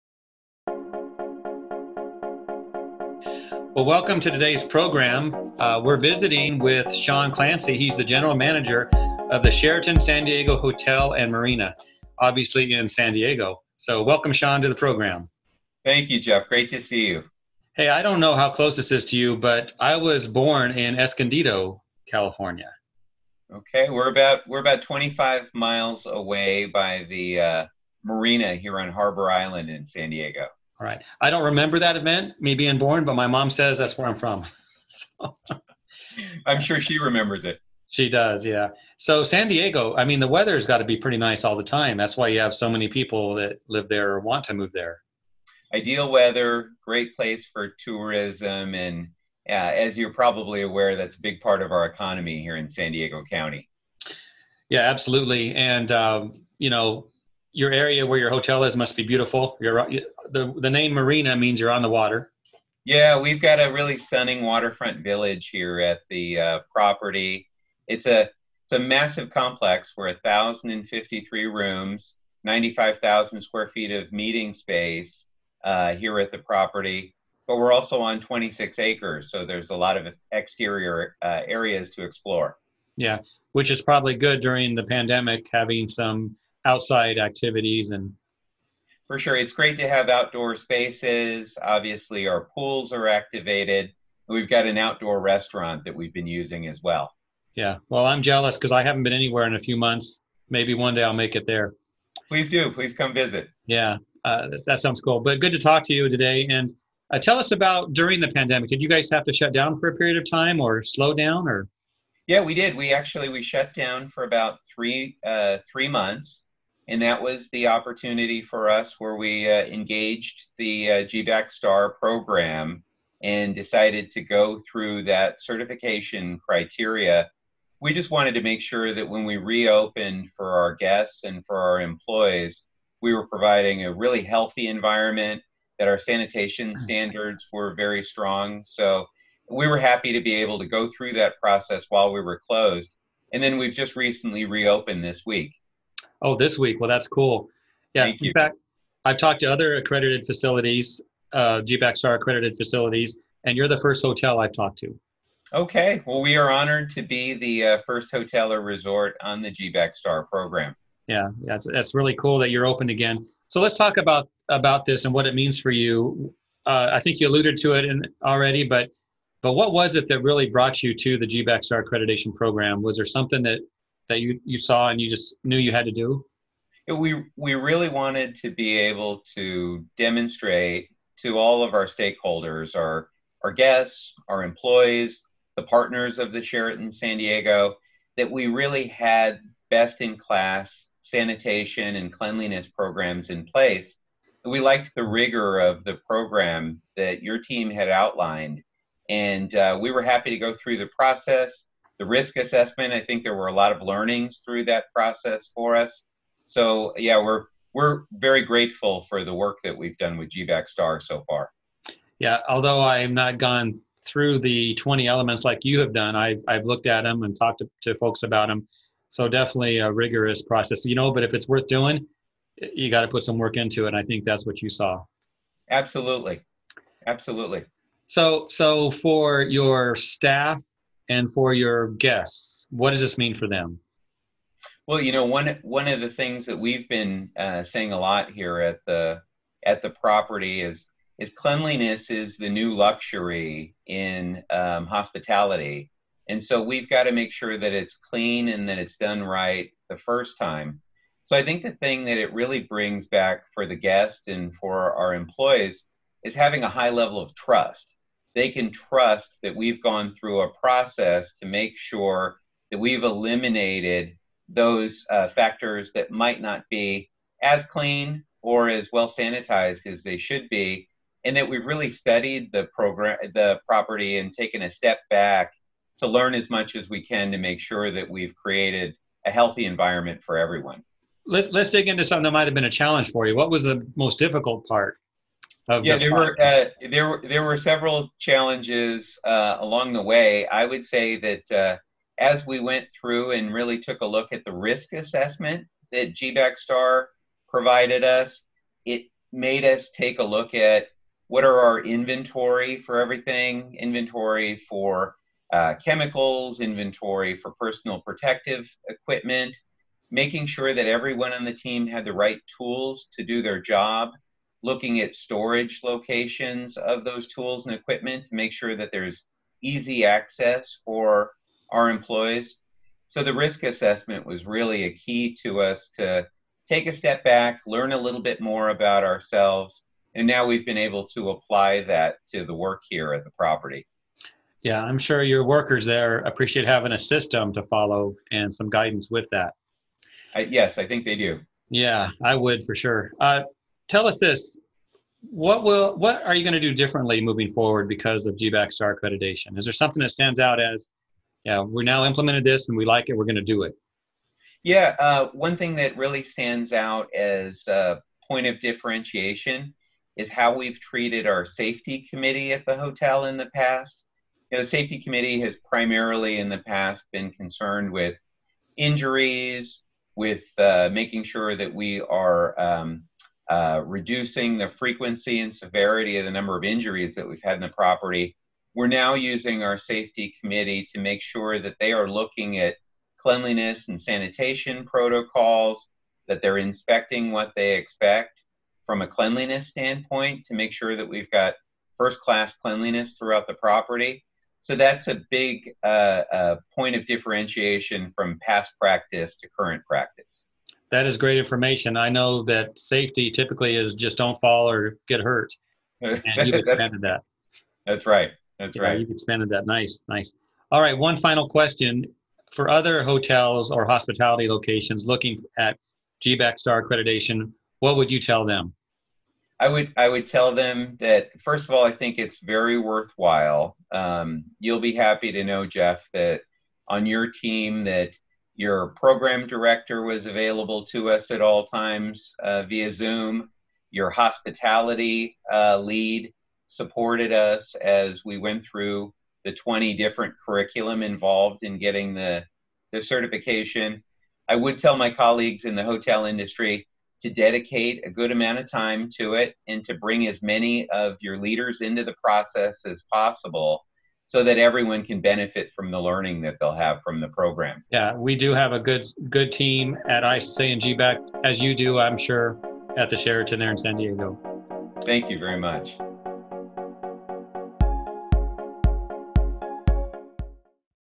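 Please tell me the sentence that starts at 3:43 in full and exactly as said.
And I think that's what you saw.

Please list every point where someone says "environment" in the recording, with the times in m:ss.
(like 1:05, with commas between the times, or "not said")
2:14, 4:39.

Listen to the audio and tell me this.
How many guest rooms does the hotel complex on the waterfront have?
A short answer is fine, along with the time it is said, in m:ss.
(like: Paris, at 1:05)
1,053, at 1:10.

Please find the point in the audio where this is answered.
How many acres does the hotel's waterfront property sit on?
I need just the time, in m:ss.
1:18.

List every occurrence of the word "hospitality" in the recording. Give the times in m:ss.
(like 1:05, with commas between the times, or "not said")
4:04, 6:53, 7:14.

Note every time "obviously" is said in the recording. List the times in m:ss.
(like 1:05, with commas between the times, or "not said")
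0:12, 1:31.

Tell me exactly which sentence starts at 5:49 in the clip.
Is there something that stands out as, yeah, we're now implemented this and we like it, we're going to do it?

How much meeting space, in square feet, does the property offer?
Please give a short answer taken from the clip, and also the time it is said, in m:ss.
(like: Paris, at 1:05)
95,000 square feet, at 1:12.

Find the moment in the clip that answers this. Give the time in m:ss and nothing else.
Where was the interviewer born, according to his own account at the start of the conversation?
0:20.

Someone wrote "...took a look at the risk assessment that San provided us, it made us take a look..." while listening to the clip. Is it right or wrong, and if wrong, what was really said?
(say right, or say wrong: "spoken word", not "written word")
wrong: "GBAC", not "San".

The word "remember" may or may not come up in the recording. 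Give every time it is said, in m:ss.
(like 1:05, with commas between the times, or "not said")
0:31, 0:36.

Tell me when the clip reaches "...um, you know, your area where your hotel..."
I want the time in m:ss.
0:55.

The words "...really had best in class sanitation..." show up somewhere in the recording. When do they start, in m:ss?
3:08.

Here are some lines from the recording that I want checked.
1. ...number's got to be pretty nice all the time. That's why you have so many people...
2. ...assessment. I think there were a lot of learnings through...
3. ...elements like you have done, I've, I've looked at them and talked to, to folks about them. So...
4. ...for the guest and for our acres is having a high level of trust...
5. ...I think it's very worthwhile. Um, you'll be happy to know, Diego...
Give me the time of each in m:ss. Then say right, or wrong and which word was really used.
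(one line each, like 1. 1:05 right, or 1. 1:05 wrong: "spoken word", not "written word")
1. 0:40 wrong: "weather", not "number"
2. 3:22 right
3. 3:35 right
4. 4:13 wrong: "employees", not "acres"
5. 7:01 wrong: "Jeff", not "Diego".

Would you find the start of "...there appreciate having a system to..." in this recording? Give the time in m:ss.
5:35.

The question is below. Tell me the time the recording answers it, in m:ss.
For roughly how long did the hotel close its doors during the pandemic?
1:55.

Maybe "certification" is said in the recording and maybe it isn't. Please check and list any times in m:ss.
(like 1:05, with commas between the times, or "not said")
2:05, 7:23.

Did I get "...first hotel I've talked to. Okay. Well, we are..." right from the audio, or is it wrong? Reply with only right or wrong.
right.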